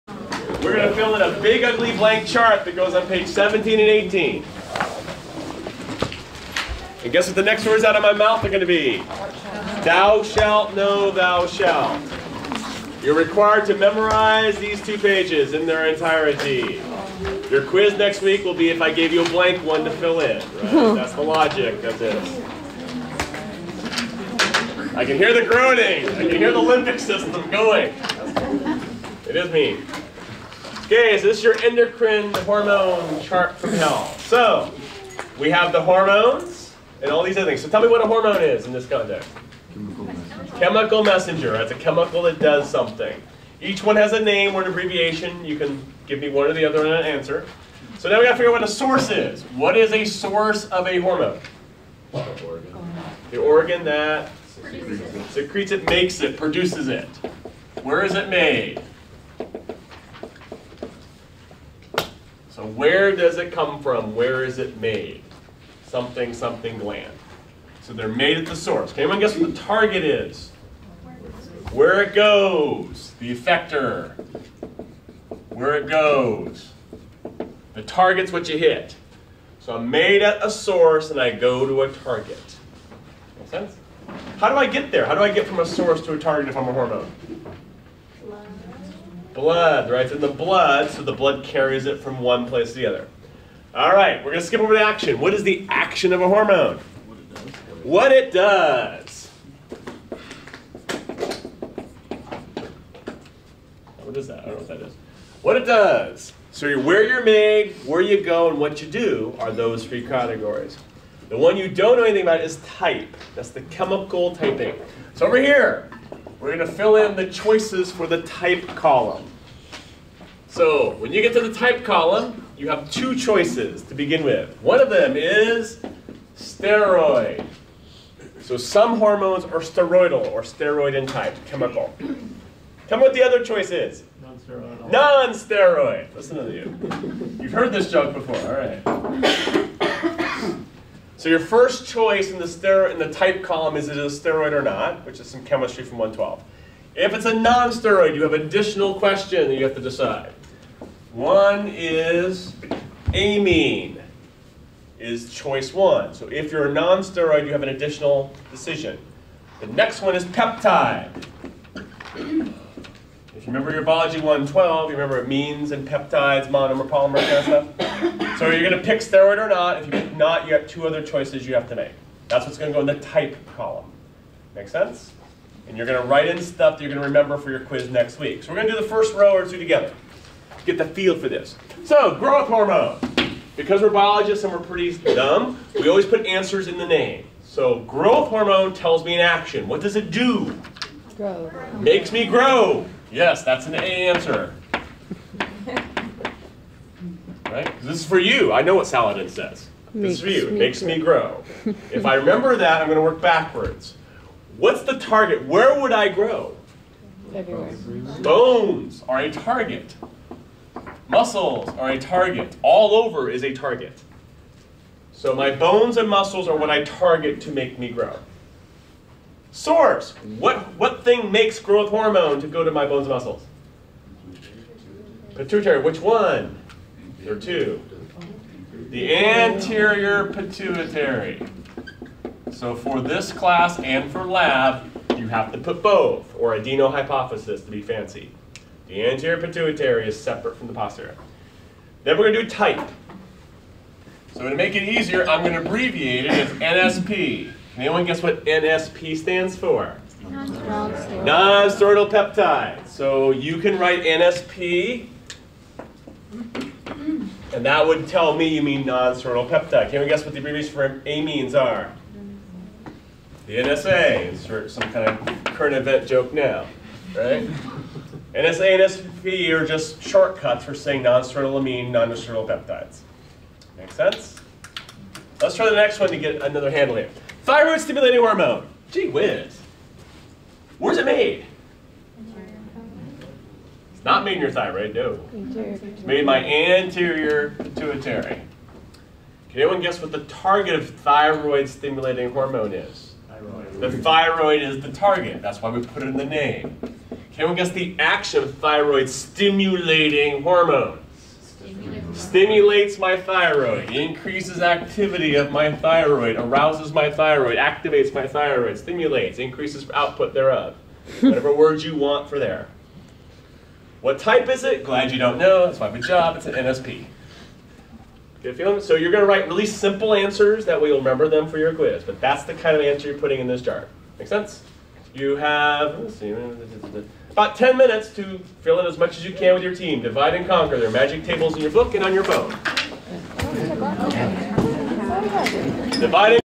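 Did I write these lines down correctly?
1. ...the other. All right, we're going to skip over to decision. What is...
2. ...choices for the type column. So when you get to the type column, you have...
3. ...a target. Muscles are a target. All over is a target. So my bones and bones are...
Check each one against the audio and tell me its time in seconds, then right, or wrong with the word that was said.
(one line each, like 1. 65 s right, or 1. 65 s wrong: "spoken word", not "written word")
1. 92 s wrong: "action", not "decision"
2. 117 s right
3. 209 s wrong: "muscles", not "bones".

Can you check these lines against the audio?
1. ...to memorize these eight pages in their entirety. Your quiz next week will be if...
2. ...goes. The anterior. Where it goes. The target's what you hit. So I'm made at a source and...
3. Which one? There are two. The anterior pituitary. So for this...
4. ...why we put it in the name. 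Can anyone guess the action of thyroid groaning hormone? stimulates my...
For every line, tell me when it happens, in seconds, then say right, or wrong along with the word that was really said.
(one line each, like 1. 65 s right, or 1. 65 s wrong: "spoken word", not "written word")
1. 13 s wrong: "two", not "eight"
2. 72 s wrong: "effector", not "anterior"
3. 225 s right
4. 295 s wrong: "stimulating", not "groaning".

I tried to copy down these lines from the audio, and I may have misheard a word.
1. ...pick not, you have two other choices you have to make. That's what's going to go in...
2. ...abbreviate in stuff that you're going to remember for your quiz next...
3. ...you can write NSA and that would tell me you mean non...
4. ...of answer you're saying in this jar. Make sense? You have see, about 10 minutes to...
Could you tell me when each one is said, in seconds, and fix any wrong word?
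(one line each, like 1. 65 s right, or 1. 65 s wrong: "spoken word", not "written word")
1. 169 s right
2. 176 s wrong: "write", not "abbreviate"
3. 253 s wrong: "NSP", not "NSA"
4. 322 s wrong: "putting", not "saying".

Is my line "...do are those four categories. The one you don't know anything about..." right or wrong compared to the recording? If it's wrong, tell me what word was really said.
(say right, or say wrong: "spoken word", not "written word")
wrong: "three", not "four".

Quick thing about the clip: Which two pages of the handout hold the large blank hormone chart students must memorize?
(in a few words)
17 and 18.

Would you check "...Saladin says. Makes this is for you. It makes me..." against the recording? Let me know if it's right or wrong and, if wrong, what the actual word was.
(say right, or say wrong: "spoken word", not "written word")
right.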